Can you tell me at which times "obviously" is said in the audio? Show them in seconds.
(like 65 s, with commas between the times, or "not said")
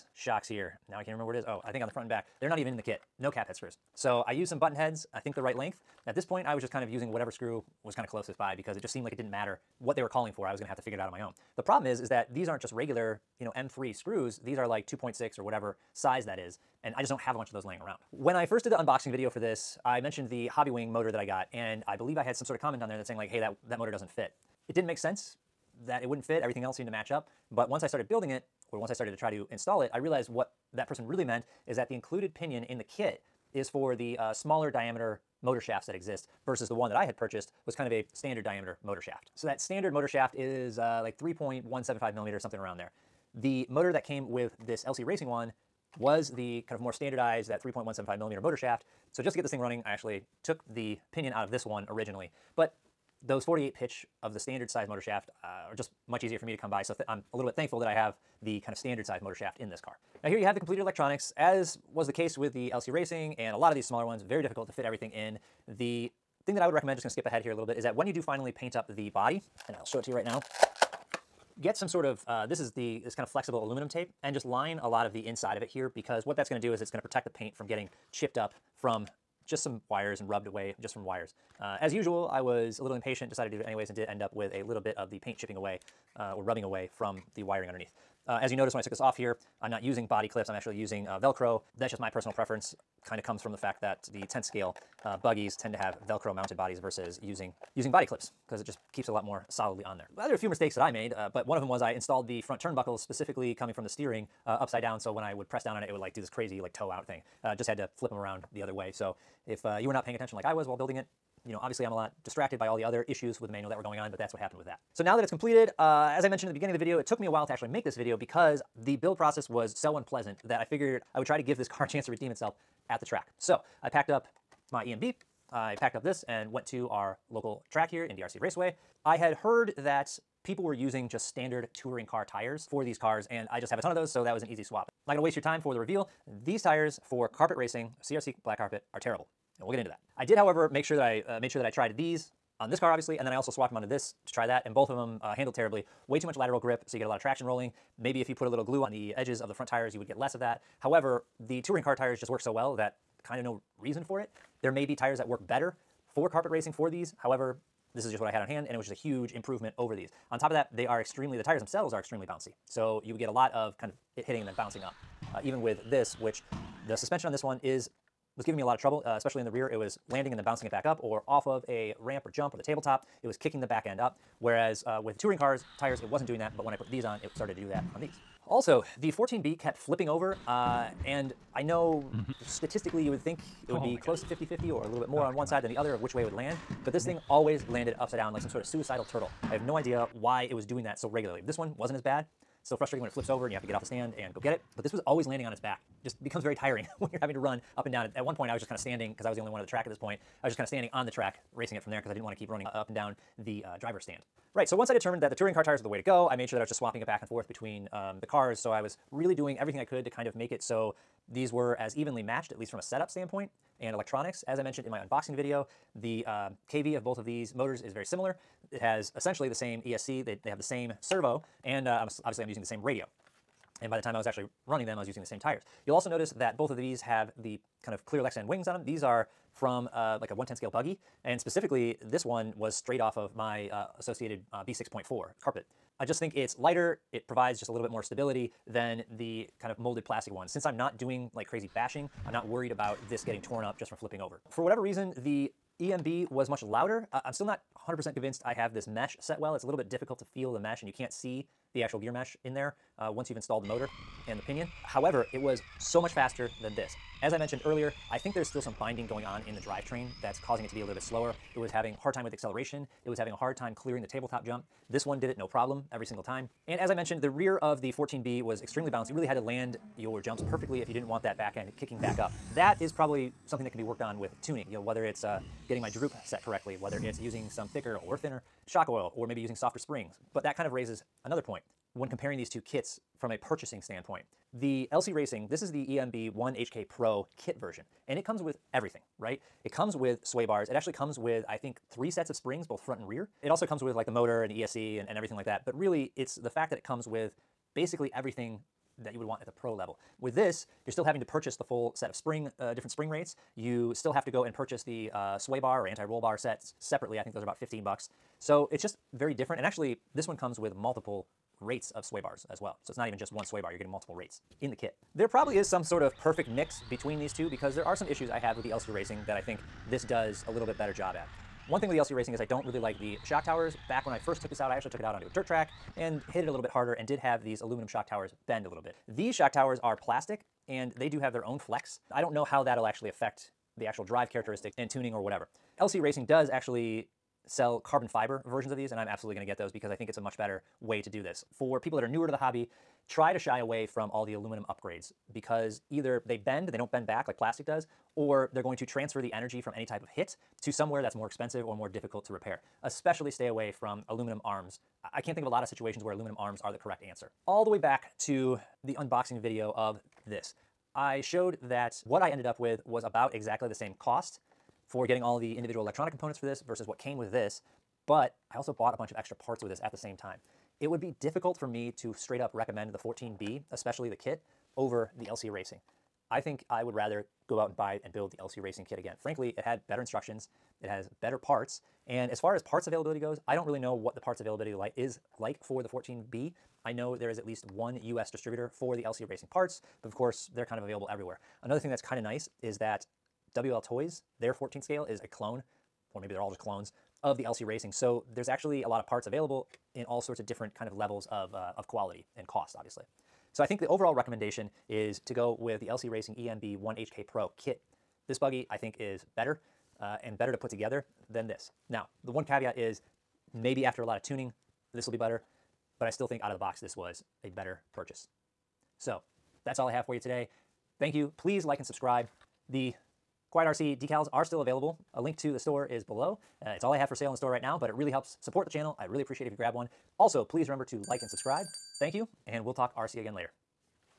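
111 s, 142 s, 222 s, 402 s.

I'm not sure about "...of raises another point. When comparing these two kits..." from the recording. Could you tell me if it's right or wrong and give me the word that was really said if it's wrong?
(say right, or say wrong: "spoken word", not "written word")
right.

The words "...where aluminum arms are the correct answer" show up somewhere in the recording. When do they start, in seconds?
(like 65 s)
356 s.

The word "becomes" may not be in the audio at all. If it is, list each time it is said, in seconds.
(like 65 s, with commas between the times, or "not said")
196 s.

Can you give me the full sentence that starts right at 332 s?
I don't know how that'll actually affect the actual drive characteristics and tuning or whatever.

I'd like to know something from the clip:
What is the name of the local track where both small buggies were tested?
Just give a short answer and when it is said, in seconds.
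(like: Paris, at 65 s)
DRC Raceway, at 128 s.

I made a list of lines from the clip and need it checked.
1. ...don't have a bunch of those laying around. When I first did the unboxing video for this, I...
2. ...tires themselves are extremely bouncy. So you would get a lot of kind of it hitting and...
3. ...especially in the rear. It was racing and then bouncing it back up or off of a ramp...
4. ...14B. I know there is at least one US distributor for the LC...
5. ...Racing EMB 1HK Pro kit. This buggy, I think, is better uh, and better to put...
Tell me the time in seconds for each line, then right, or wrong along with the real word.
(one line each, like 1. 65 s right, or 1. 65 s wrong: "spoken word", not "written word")
1. 17 s right
2. 161 s right
3. 169 s wrong: "landing", not "racing"
4. 385 s right
5. 406 s right.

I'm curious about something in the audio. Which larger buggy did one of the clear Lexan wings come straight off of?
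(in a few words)
Associated B6.4.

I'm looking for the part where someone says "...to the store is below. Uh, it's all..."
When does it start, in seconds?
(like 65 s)
425 s.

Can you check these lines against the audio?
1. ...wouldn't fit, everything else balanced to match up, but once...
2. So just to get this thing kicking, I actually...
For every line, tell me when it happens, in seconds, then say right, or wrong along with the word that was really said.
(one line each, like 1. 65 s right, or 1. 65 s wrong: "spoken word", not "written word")
1. 26 s wrong: "seemed", not "balanced"
2. 49 s wrong: "running", not "kicking".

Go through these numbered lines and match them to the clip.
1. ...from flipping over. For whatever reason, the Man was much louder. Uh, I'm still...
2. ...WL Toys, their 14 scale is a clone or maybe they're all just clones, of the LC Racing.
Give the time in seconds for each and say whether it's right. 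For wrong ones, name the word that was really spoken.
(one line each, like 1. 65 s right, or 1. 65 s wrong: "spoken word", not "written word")
1. 243 s wrong: "EMB", not "Man"
2. 393 s right.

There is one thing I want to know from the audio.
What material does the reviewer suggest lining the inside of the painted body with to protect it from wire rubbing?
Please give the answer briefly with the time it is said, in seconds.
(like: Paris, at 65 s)
Aluminum tape, at 73 s.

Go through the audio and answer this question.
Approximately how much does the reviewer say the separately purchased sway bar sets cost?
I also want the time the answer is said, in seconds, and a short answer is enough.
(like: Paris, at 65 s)
15 bucks, at 307 s.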